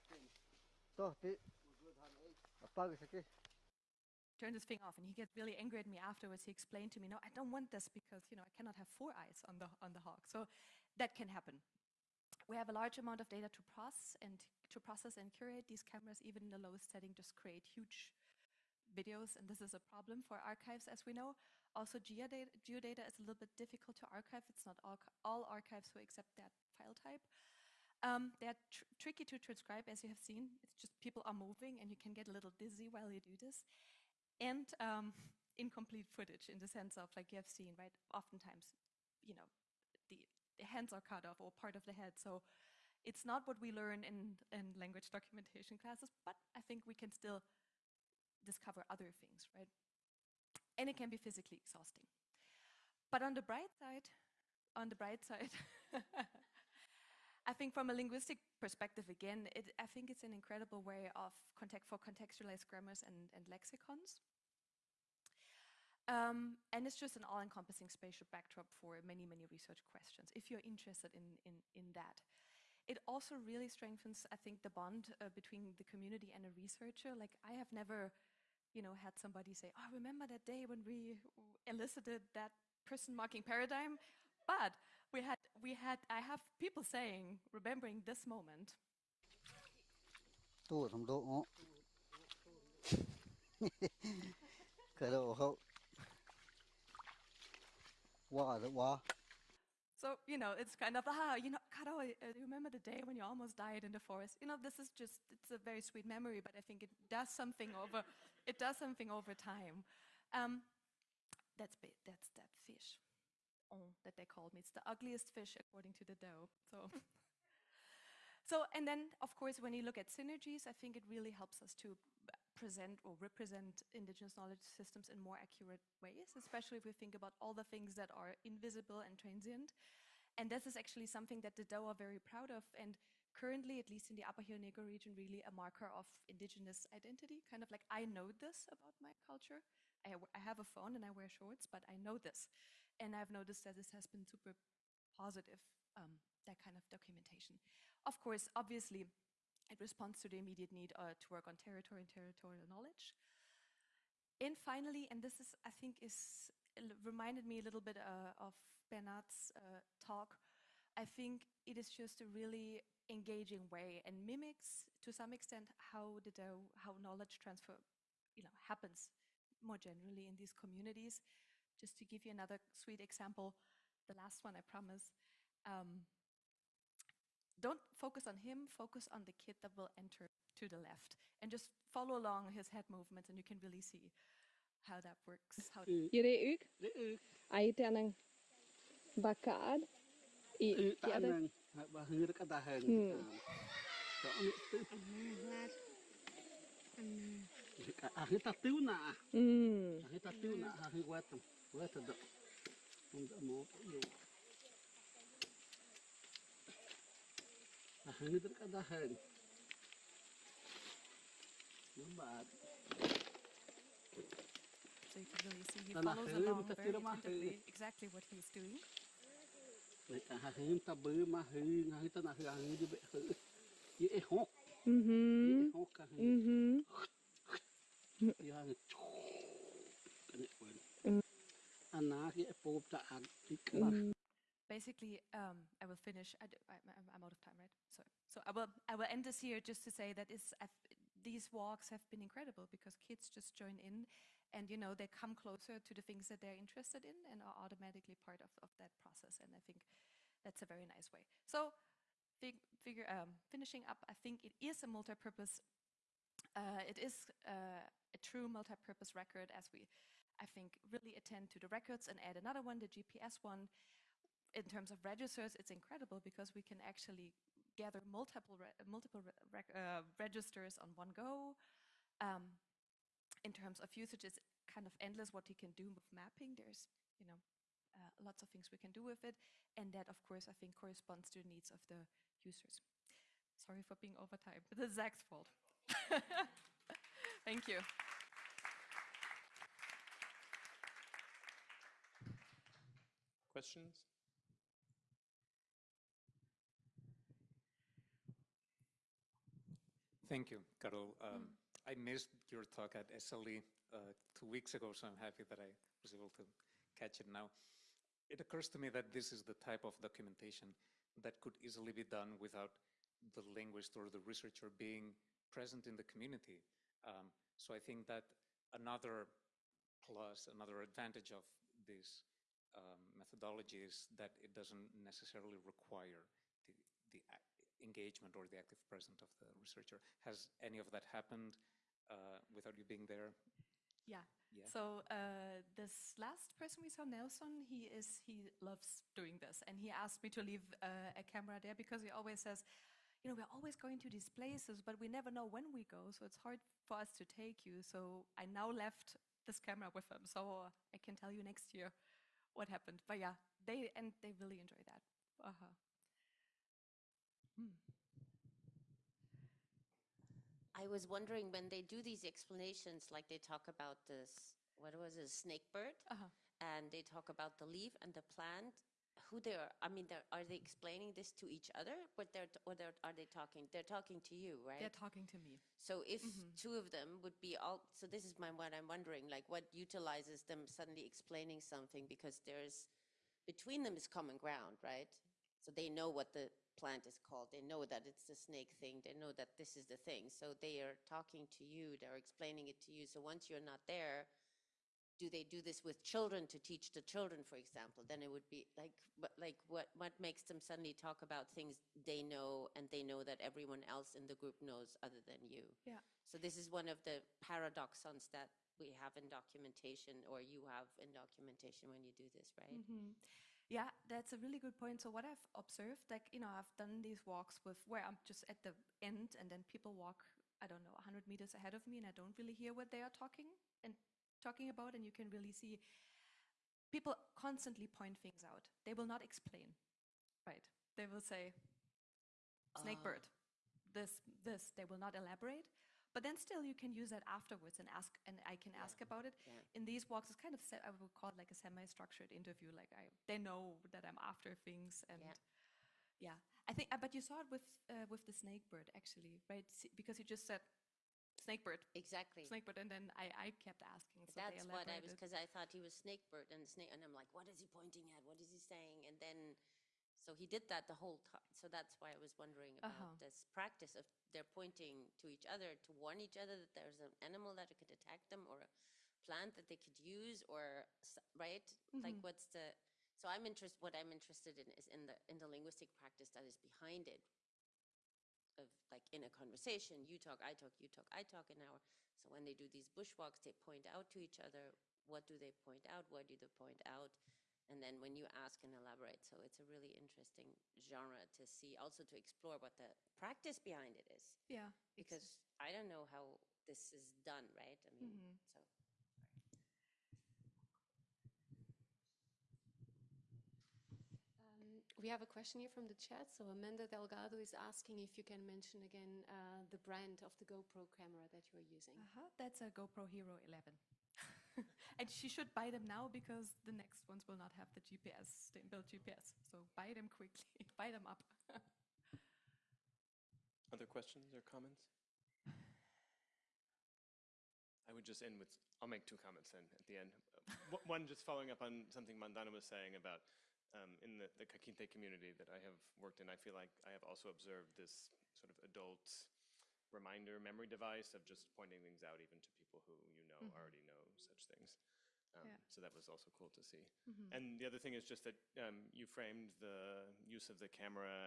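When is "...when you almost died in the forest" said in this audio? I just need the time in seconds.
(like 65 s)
103 s.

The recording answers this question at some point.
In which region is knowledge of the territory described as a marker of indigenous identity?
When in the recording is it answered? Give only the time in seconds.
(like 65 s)
134 s.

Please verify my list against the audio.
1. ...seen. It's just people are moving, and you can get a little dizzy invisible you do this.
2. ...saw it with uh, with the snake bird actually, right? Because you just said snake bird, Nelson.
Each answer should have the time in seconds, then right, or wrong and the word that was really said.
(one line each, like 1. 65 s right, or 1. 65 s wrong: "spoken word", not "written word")
1. 30 s wrong: "while", not "invisible"
2. 447 s wrong: "Exactly", not "Nelson".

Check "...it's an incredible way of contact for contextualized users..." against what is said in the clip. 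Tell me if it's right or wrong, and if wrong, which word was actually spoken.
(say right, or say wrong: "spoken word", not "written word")
wrong: "grammars", not "users".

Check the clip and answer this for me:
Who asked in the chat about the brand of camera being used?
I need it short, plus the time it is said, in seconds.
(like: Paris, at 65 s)
Amanda Delgado, at 506 s.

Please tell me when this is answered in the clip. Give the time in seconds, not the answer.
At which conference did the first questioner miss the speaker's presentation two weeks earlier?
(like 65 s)
303 s.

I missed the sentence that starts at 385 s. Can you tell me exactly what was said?
So they know what the plant is called.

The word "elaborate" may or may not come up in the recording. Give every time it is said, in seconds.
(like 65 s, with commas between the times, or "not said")
435 s, 488 s.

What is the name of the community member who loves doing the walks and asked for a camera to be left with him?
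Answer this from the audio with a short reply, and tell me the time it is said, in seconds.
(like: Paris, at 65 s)
Nelson, at 337 s.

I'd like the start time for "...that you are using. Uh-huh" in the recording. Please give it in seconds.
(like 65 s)
511 s.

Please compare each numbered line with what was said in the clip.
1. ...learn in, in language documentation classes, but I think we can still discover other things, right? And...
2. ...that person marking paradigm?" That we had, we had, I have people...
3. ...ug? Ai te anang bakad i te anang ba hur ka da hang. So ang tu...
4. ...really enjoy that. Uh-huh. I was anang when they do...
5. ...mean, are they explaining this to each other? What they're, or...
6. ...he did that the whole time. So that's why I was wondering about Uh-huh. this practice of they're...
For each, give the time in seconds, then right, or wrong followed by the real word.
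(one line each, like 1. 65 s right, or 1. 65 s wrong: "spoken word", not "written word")
1. 43 s right
2. 82 s wrong: "But", not "That"
3. 186 s right
4. 354 s wrong: "wondering", not "anang"
5. 369 s right
6. 460 s right.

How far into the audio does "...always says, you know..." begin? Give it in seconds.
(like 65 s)
342 s.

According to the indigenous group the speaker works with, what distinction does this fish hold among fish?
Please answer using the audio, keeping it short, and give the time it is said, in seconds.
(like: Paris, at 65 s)
The ugliest fish, at 114 s.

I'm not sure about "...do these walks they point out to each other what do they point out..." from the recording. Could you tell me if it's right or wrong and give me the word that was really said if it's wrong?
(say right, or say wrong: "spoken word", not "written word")
wrong: "bushwalks", not "walks".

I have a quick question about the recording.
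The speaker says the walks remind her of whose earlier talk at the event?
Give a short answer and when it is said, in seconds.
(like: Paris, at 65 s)
Bernard, at 158 s.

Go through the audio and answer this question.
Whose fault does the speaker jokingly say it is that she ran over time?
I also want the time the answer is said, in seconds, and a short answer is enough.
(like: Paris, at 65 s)
Zach, at 284 s.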